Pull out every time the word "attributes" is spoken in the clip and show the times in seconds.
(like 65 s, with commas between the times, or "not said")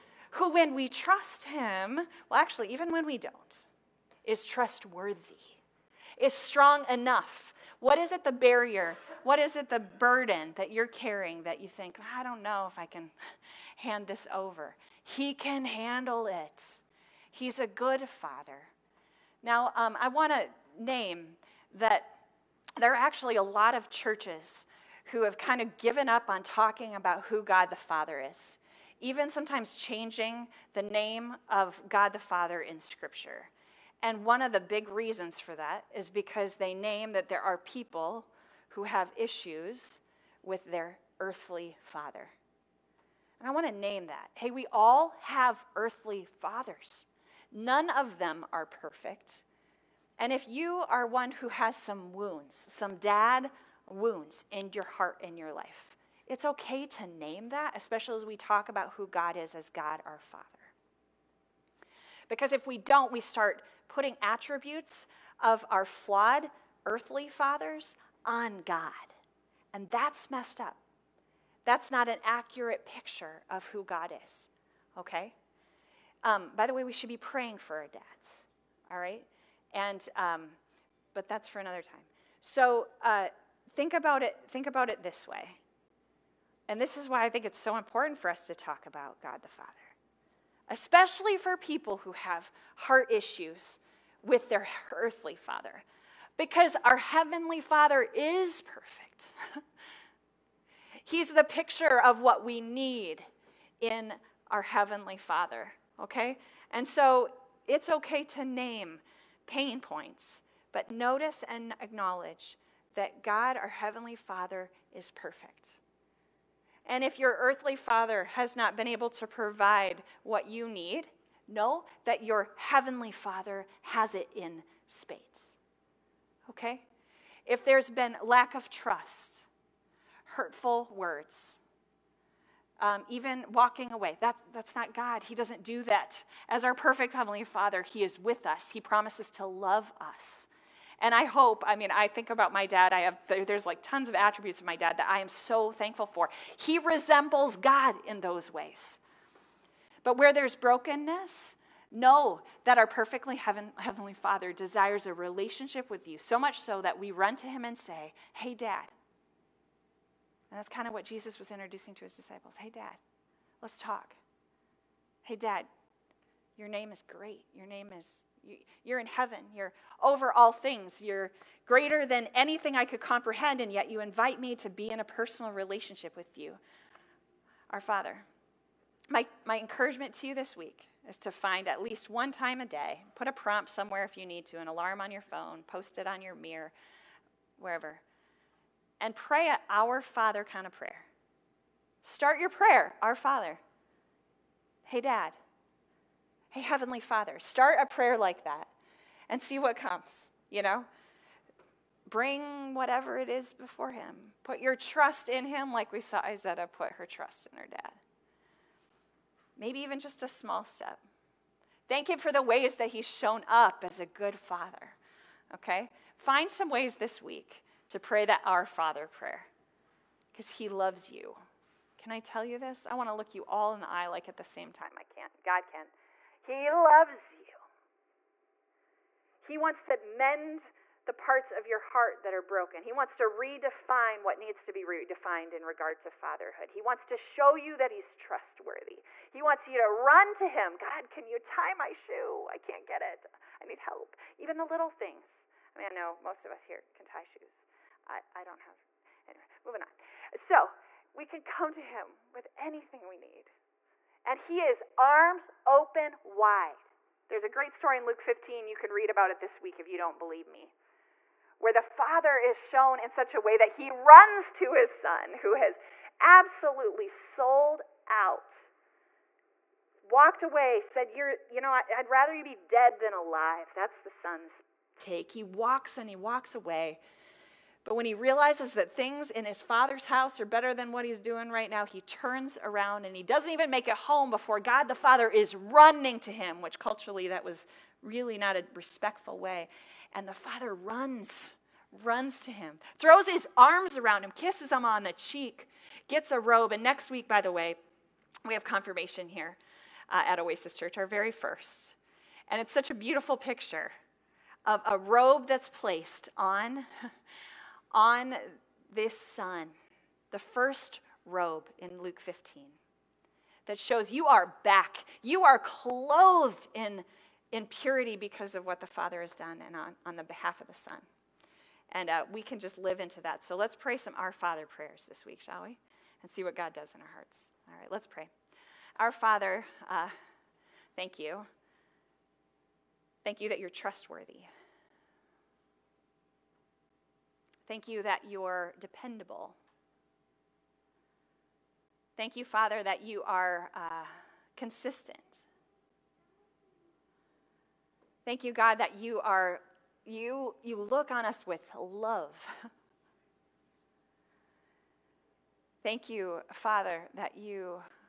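64 s, 144 s.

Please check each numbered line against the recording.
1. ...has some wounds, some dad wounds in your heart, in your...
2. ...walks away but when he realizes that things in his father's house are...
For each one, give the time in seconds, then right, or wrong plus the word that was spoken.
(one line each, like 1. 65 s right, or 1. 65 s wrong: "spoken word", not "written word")
1. 51 s right
2. 276 s right.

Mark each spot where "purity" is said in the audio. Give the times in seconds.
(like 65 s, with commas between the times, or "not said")
317 s.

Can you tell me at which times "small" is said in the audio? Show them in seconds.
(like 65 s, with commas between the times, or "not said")
210 s.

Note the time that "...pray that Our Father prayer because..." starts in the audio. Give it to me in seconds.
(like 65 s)
217 s.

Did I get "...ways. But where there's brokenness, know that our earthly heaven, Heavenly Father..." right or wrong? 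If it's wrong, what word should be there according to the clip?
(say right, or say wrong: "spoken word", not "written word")
wrong: "perfectly", not "earthly".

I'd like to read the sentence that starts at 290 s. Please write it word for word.
And the father runs, runs to him, throws his arms around him, kisses him on the cheek, gets a robe.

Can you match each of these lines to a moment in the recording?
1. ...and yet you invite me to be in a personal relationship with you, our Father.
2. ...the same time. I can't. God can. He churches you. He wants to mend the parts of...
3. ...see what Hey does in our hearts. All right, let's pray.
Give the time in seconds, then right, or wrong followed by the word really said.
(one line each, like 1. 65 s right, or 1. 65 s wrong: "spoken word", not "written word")
1. 173 s right
2. 224 s wrong: "loves", not "churches"
3. 326 s wrong: "God", not "Hey".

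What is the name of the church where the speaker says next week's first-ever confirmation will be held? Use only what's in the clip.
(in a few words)
Oasis Church.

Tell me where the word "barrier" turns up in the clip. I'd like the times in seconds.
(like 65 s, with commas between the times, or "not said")
8 s.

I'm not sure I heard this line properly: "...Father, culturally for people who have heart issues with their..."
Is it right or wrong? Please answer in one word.
wrong.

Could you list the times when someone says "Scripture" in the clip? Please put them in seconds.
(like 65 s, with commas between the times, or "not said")
32 s.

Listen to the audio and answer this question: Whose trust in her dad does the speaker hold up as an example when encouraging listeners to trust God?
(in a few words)
Izetta.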